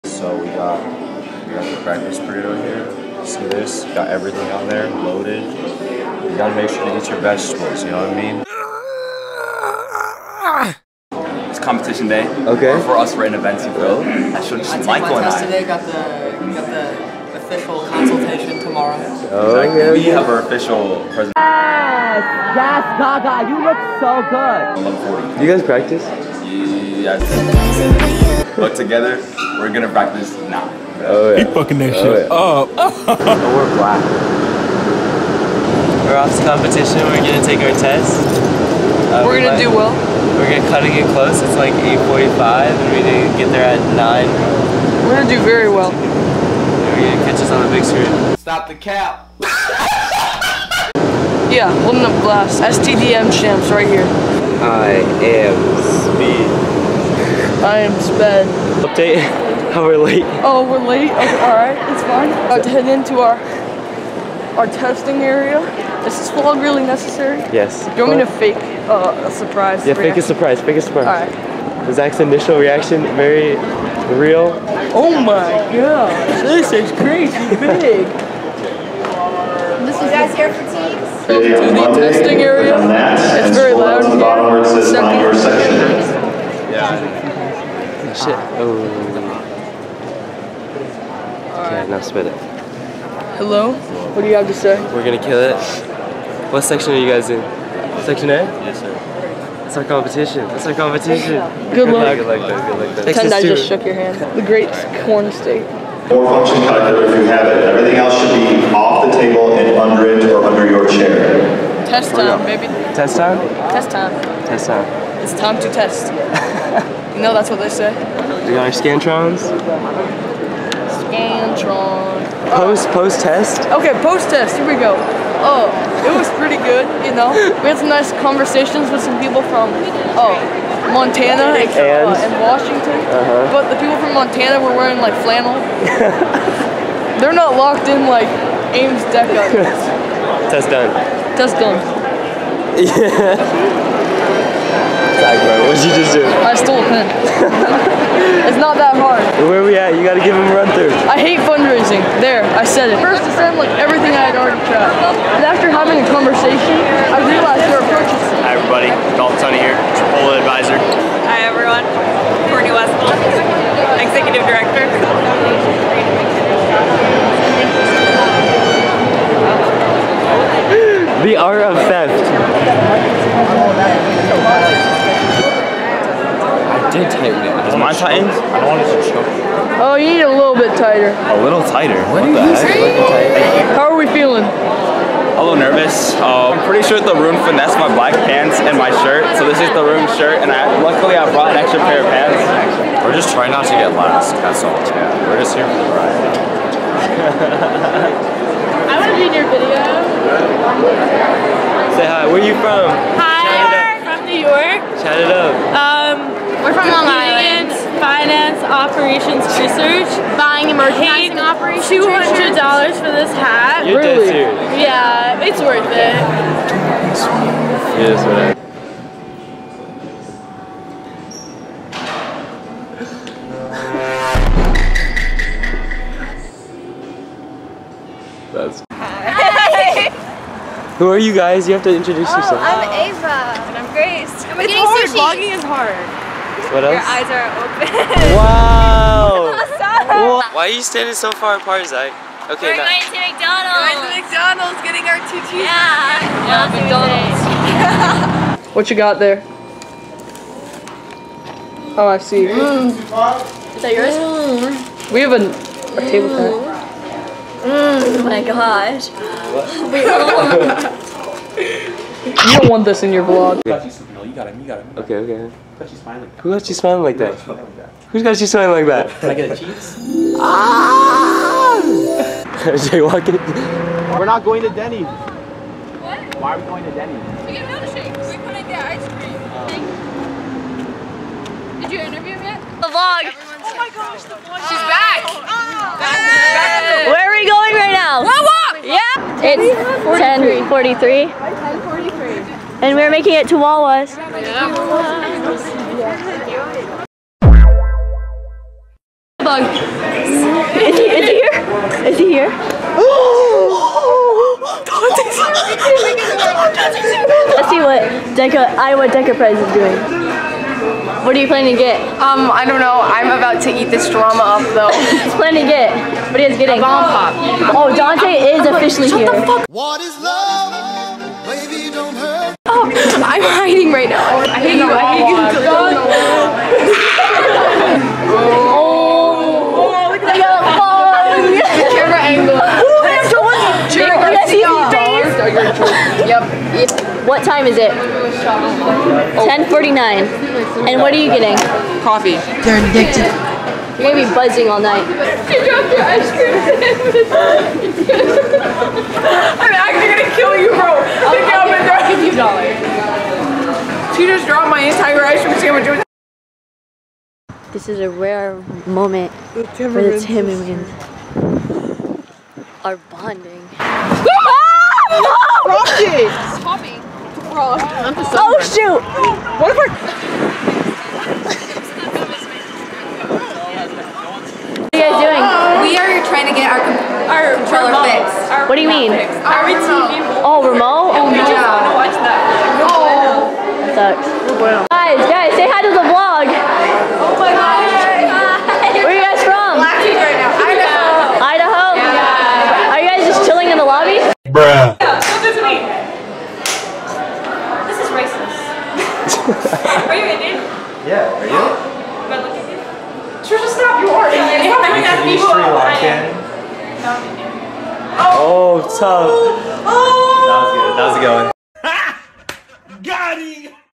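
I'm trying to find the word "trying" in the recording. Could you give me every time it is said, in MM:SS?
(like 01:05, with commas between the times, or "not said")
03:13, 06:16.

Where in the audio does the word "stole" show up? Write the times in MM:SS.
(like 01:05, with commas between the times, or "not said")
02:26.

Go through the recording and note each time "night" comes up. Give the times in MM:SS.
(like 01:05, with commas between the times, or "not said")
05:44.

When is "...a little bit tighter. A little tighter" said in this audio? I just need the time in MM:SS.
03:00.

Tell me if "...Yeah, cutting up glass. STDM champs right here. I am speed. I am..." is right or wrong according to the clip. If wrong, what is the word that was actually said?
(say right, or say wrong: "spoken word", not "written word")
wrong: "holding", not "cutting".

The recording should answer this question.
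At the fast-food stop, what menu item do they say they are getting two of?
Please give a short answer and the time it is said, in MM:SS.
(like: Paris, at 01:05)
Cheeseburgers, at 04:05.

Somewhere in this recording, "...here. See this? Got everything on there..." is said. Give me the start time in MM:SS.
00:02.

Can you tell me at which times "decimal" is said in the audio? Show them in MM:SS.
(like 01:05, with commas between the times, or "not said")
not said.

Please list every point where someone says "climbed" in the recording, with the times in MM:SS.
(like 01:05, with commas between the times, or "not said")
not said.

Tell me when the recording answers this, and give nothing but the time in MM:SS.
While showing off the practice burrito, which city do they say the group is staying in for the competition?
00:13.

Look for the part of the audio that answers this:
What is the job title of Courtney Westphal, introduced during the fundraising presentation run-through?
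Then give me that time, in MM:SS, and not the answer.
02:44.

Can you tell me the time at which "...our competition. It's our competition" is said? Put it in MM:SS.
01:39.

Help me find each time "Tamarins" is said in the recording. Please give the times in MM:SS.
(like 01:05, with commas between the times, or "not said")
06:00.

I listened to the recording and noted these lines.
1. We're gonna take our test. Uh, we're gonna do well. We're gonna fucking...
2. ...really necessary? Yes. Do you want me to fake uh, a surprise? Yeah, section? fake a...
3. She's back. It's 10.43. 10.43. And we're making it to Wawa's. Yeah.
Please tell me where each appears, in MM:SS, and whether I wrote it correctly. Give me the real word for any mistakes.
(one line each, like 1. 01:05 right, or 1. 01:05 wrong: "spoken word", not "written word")
1. 00:37 wrong: "cutting", not "fucking"
2. 01:06 wrong: "reaction", not "section"
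3. 04:44 right.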